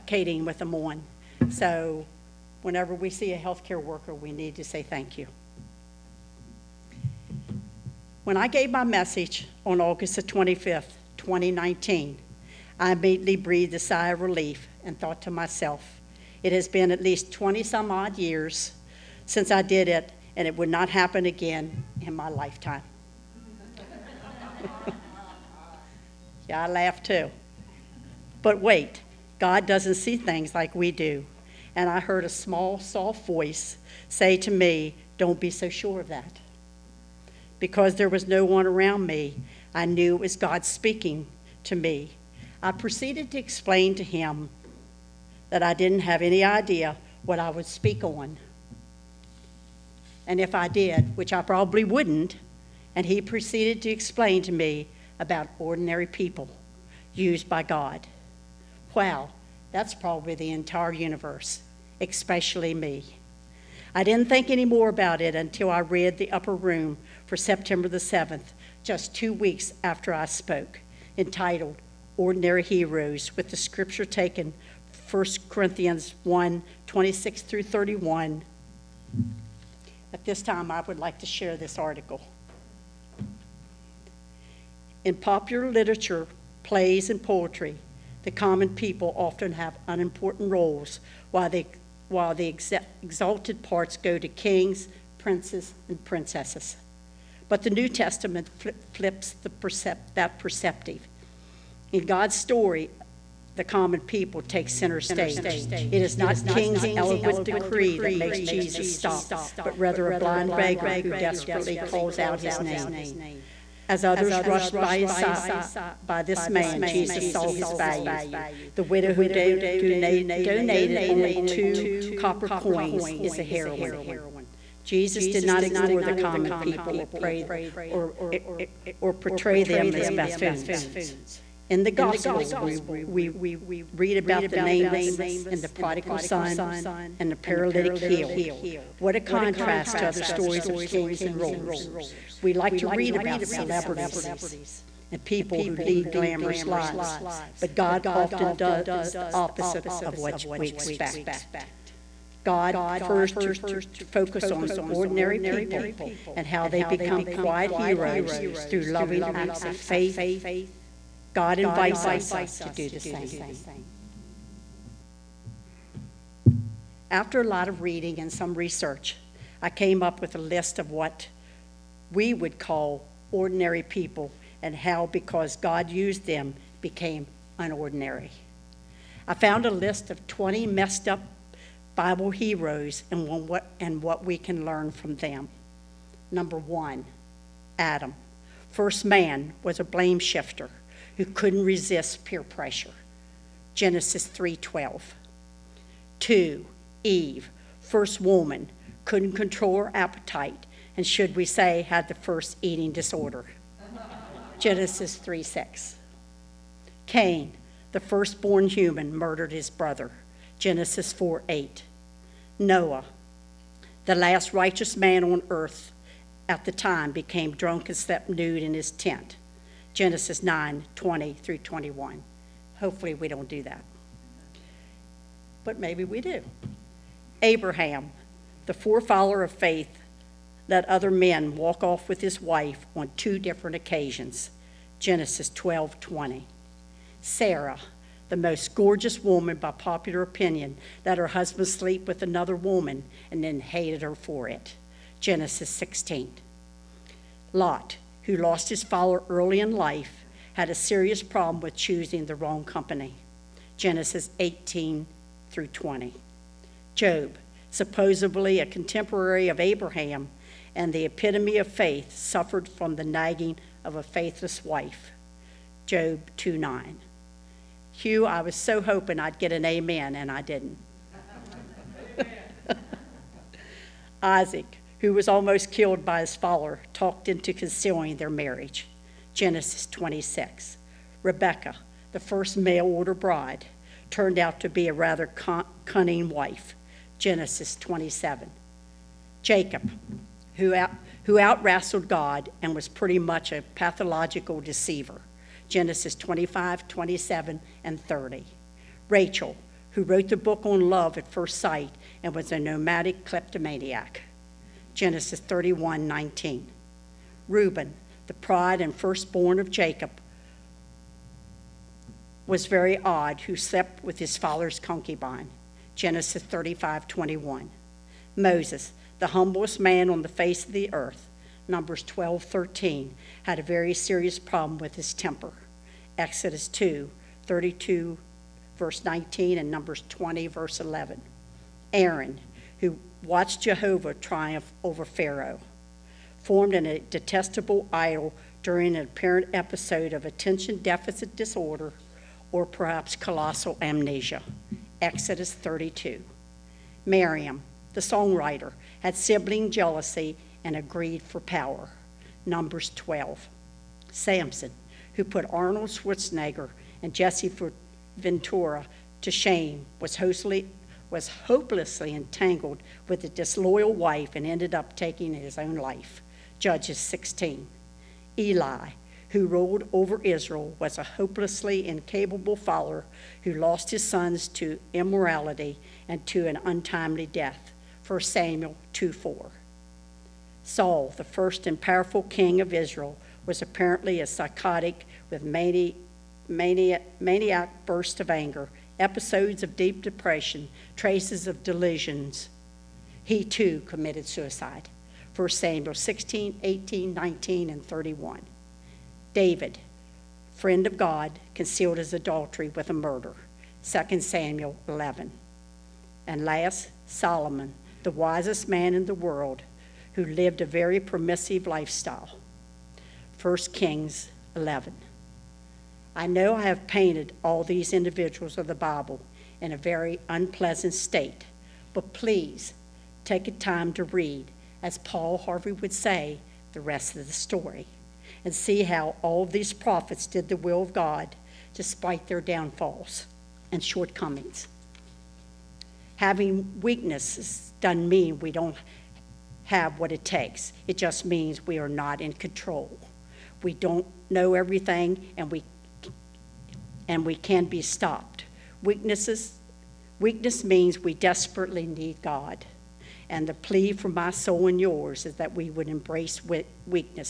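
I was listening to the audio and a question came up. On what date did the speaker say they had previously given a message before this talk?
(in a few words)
August 25, 2019.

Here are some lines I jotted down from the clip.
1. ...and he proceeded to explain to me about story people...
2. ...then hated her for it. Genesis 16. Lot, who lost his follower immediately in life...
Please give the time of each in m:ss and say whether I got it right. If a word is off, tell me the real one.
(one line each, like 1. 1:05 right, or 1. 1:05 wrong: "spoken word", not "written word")
1. 0:52 wrong: "ordinary", not "story"
2. 4:03 wrong: "early", not "immediately".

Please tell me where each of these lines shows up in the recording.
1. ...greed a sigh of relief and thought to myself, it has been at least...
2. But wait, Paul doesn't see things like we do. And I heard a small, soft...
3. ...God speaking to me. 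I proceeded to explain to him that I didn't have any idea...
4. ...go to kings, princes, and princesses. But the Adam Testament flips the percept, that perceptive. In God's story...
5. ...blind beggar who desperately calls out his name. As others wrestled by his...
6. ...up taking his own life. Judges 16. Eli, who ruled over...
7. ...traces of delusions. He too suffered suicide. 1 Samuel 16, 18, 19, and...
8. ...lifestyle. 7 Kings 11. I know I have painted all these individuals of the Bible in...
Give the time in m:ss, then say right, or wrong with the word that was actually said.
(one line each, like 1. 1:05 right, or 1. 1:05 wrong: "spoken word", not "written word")
1. 0:13 wrong: "breathed", not "greed"
2. 0:28 wrong: "God", not "Paul"
3. 0:40 right
4. 1:33 wrong: "New", not "Adam"
5. 1:50 wrong: "rushed", not "wrestled"
6. 6:04 right
7. 6:30 wrong: "committed", not "suffered"
8. 6:51 wrong: "1", not "7".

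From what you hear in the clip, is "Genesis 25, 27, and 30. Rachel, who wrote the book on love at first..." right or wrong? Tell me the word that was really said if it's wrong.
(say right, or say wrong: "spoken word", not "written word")
right.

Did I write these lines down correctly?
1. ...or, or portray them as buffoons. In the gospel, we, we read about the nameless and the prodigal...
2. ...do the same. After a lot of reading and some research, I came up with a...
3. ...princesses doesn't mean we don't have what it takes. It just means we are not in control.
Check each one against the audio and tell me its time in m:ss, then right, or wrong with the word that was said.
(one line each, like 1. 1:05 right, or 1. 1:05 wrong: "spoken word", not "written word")
1. 2:07 right
2. 2:42 right
3. 7:16 wrong: "weaknesses", not "princesses".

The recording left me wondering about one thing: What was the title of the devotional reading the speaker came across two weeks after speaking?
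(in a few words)
Ordinary Heroes.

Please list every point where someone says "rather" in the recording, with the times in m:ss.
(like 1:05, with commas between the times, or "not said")
1:49, 4:44.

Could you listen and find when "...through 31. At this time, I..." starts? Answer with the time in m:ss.
1:17.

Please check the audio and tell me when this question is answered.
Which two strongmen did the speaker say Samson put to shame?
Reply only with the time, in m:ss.
5:55.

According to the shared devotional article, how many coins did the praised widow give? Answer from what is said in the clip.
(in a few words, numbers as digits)
2.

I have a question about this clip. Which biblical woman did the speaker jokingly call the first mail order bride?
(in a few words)
Rebecca.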